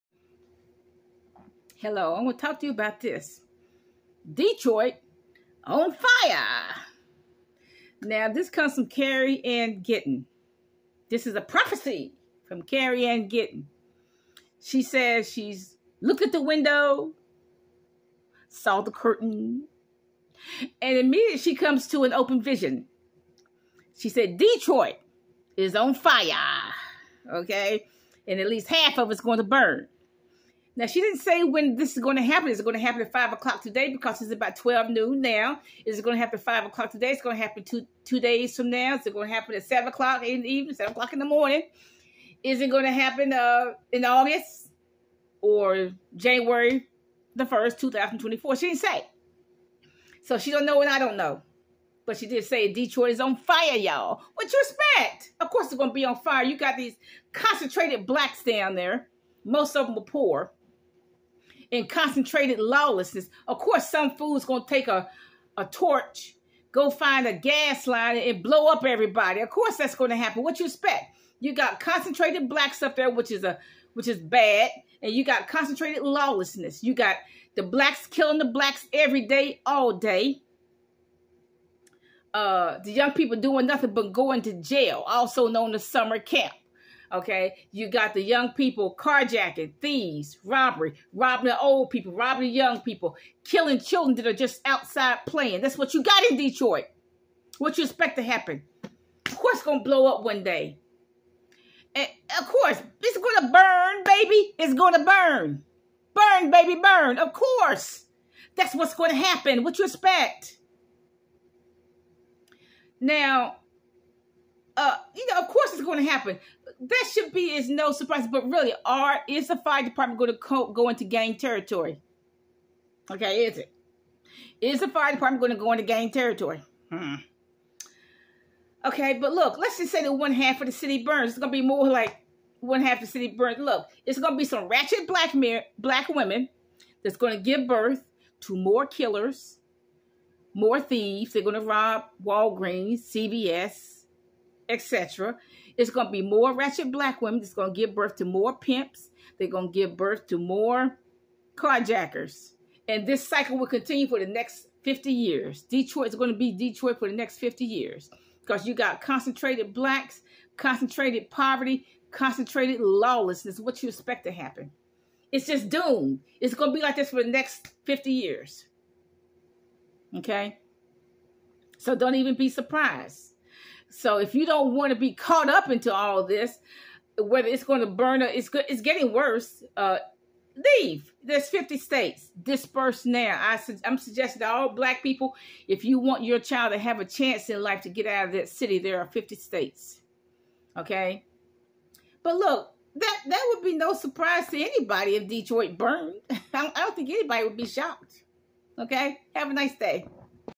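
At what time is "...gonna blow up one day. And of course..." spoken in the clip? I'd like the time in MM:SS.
01:39.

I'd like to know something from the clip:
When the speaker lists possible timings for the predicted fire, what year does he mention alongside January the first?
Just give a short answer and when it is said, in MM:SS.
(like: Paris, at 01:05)
2024, at 00:47.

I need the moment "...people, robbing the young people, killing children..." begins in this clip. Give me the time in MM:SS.
01:31.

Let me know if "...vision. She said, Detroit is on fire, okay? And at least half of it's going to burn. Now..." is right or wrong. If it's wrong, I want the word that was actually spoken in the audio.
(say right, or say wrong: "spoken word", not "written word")
right.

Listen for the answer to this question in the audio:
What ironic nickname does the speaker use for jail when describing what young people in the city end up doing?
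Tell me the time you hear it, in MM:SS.
01:25.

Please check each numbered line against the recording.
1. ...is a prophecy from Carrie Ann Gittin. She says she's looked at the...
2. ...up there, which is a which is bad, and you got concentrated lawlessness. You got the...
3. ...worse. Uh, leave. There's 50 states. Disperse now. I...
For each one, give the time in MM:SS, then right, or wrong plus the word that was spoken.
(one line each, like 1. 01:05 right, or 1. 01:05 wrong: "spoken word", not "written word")
1. 00:11 right
2. 01:12 right
3. 02:59 right.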